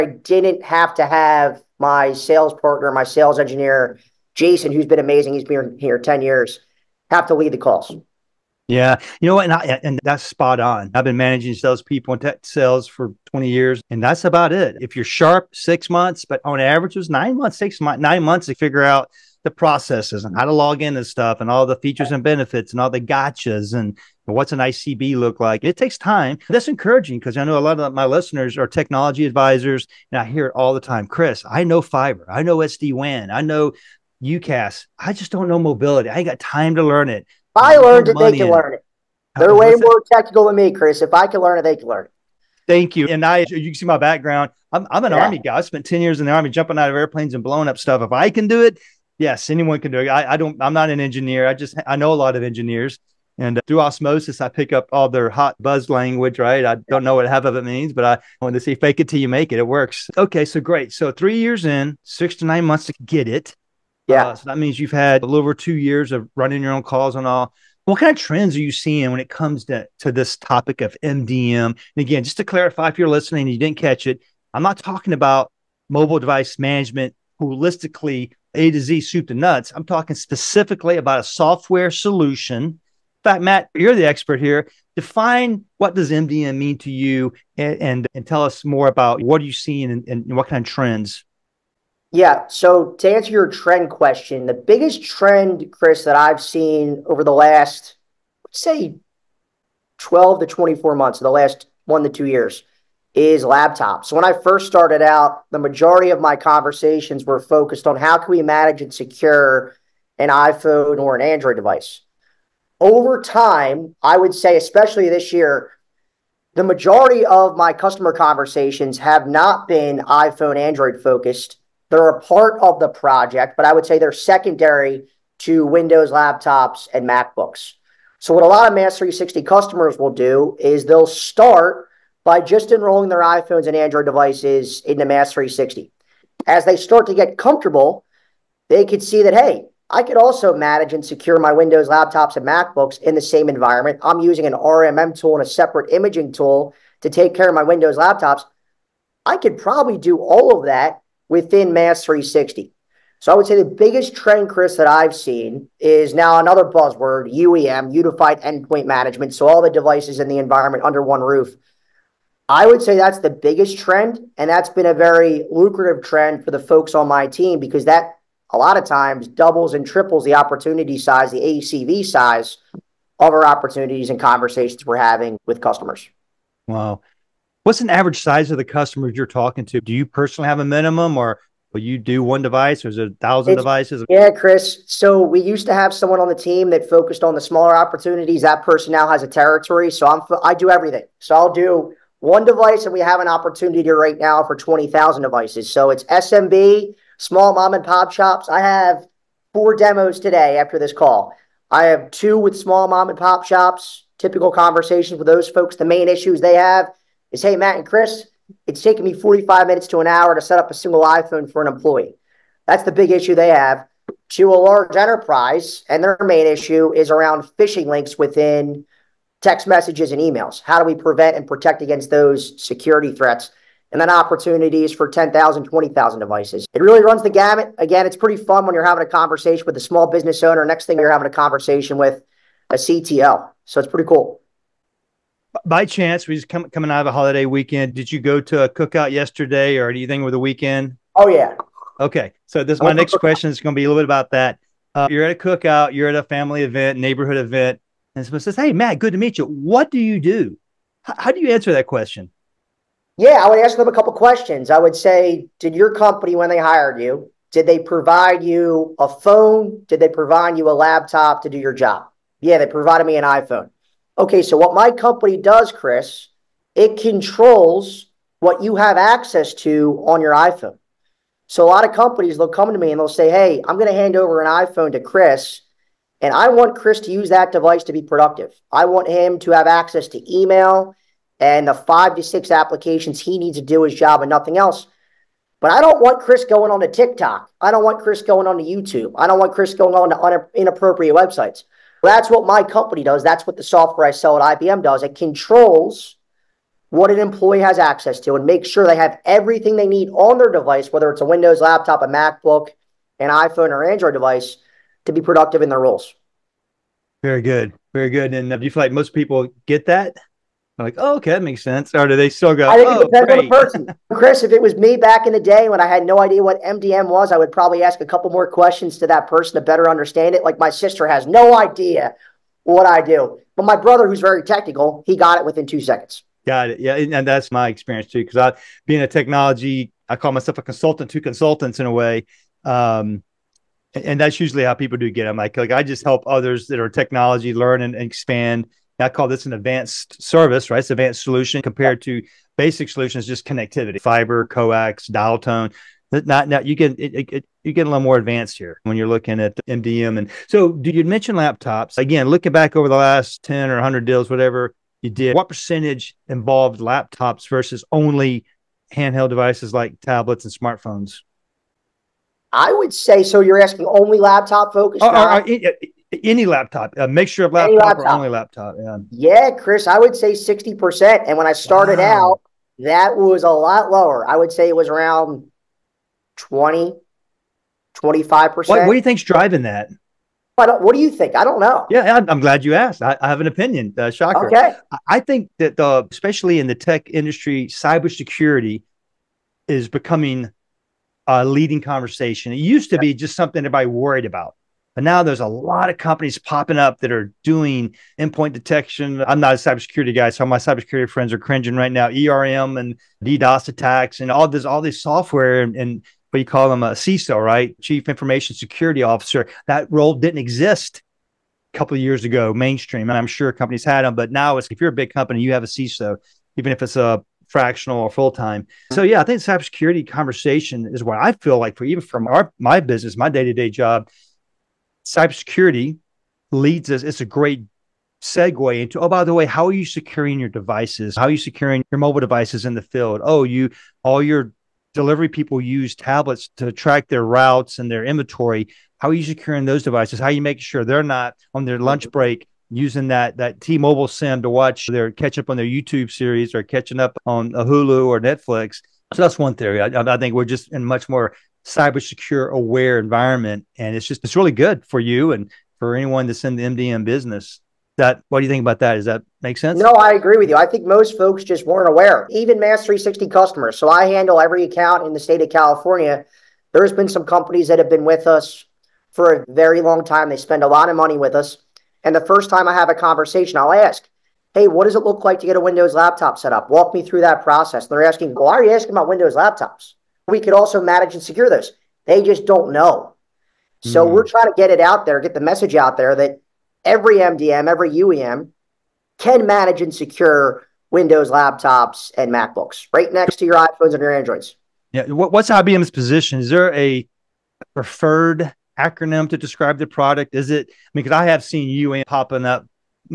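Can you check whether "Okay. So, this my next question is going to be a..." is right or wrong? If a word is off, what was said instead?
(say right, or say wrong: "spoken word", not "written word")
right.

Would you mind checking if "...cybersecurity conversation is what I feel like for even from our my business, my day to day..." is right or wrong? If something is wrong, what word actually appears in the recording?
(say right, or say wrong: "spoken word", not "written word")
right.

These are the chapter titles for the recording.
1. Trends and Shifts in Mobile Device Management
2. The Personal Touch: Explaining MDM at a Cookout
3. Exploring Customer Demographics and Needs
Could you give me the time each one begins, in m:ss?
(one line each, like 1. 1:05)
1. 1:34
2. 4:21
3. 3:23.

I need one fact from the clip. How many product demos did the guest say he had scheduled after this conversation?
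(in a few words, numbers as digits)
4.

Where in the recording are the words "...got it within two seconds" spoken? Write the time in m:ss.
5:25.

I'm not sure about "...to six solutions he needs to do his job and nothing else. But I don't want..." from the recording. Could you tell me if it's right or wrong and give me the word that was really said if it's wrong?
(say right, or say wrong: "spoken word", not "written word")
wrong: "applications", not "solutions".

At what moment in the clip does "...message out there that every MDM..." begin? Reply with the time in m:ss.
8:05.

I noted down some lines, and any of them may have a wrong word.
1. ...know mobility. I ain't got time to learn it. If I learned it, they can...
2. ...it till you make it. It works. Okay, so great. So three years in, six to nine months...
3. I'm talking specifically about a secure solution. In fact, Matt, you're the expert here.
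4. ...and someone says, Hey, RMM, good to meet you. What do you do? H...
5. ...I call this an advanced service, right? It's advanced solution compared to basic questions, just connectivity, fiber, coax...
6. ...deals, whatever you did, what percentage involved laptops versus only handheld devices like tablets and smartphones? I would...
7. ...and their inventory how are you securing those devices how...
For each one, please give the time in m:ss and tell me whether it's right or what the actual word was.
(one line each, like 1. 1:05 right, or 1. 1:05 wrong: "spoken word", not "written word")
1. 0:35 right
2. 0:59 right
3. 1:19 wrong: "software", not "secure"
4. 4:08 wrong: "Matt", not "RMM"
5. 5:39 wrong: "solutions", not "questions"
6. 5:54 right
7. 7:17 right.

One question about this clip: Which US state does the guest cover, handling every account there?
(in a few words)
California.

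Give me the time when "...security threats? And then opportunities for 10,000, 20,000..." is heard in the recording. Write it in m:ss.
3:42.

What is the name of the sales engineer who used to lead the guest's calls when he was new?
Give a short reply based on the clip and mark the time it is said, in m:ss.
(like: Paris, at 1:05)
Jason, at 0:04.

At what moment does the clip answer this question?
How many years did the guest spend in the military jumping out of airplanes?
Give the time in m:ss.
0:45.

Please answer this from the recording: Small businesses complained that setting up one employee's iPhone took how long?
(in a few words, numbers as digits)
45 minutes to an hour.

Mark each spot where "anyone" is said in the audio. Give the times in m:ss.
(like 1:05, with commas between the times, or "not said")
0:49, 7:35.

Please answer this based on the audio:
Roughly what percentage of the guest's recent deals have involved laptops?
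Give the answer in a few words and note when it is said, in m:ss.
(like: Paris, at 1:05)
60%, at 6:10.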